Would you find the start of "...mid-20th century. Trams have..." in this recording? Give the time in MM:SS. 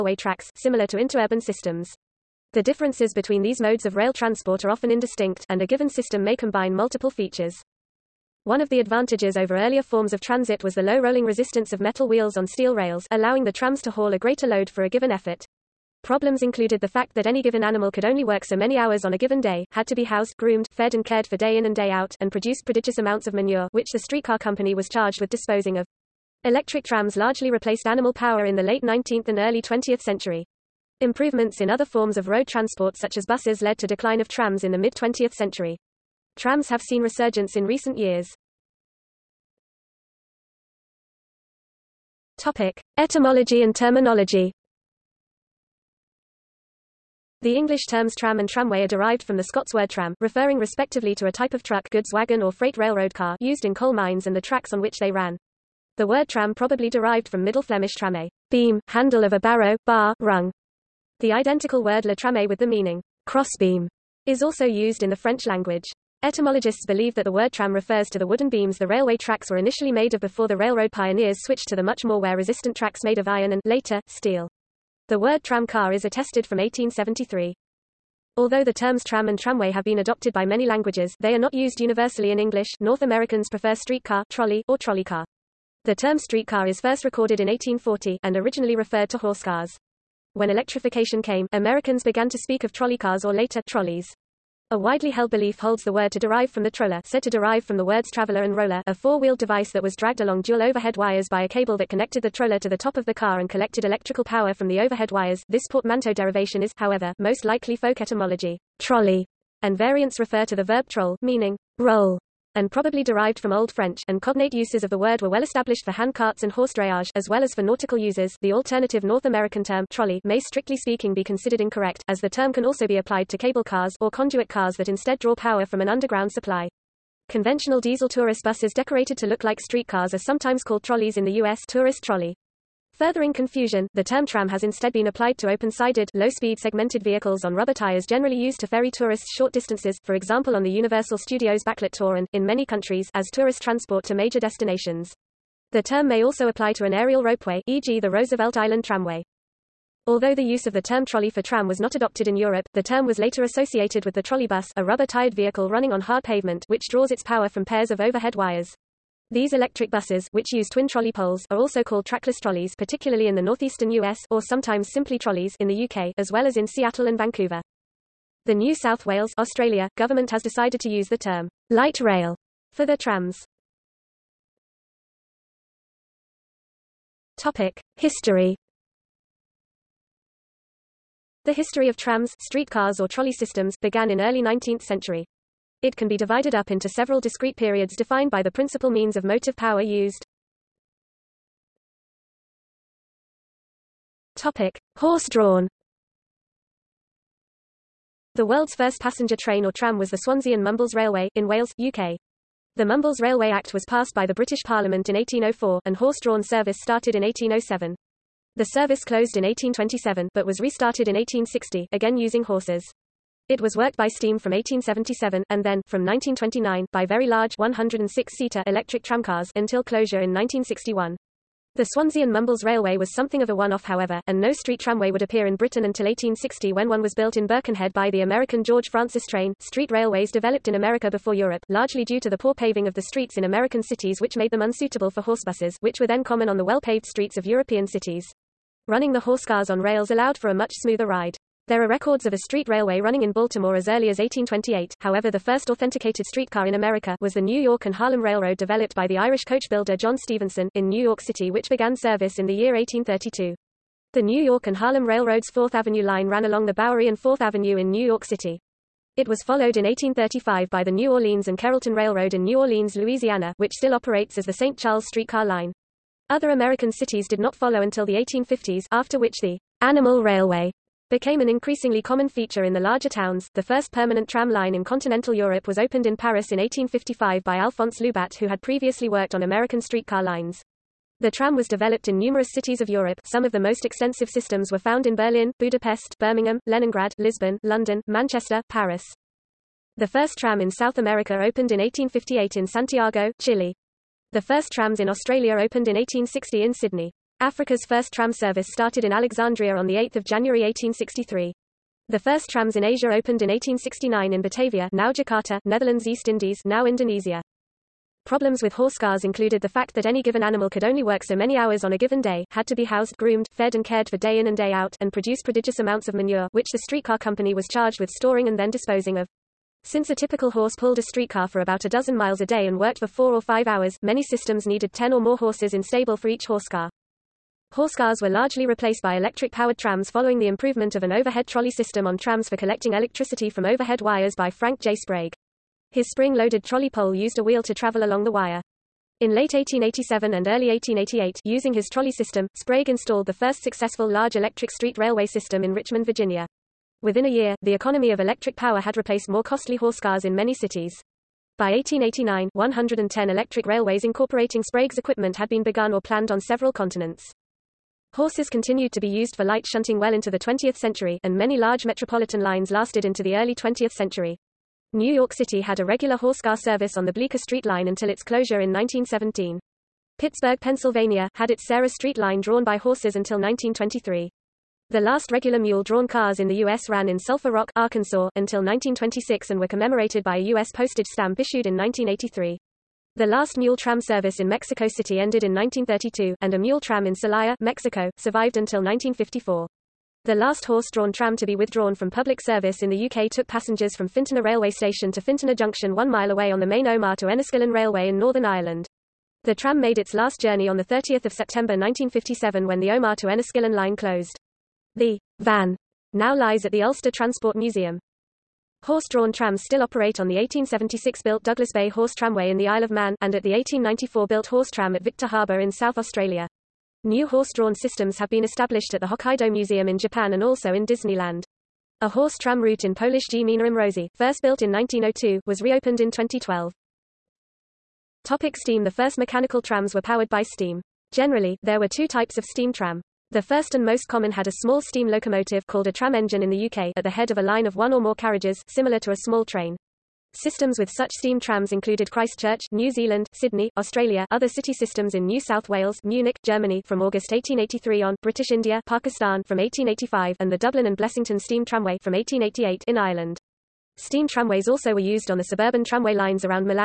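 00:34.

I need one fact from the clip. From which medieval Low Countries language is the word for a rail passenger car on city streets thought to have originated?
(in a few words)
Middle Flemish.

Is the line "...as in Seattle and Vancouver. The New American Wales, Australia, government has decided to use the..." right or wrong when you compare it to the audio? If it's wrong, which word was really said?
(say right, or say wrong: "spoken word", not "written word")
wrong: "South", not "American".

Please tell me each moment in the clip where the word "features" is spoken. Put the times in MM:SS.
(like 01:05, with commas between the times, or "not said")
00:07, 04:32.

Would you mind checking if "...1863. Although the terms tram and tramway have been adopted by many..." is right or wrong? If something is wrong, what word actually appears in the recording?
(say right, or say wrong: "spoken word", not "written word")
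wrong: "1873", not "1863".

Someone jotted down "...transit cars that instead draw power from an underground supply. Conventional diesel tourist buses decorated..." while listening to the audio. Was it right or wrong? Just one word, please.
wrong.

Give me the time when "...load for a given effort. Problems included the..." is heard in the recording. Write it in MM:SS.
00:14.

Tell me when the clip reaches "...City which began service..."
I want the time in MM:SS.
04:11.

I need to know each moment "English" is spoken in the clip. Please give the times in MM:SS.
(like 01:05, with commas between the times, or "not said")
00:47, 01:22.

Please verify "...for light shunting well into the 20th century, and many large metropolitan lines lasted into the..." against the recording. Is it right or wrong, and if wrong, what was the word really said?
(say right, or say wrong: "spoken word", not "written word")
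right.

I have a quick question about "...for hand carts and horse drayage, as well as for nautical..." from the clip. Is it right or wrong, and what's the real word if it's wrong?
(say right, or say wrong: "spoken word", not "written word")
right.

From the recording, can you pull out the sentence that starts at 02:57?
Topic: History The history of trams, streetcars or trolley systems, began in early 19th century.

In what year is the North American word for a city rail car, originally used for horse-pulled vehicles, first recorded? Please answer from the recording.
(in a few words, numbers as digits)
1840.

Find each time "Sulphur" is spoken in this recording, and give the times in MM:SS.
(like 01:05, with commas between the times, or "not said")
06:17.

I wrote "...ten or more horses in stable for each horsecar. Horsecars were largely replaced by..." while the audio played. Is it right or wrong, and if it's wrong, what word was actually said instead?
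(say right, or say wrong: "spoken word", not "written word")
right.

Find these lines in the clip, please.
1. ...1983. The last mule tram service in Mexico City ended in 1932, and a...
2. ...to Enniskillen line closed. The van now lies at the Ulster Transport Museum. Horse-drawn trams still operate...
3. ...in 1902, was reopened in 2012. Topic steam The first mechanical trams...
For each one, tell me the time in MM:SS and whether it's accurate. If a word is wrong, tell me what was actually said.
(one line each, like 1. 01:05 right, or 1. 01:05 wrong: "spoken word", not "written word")
1. 06:21 right
2. 06:43 right
3. 07:04 right.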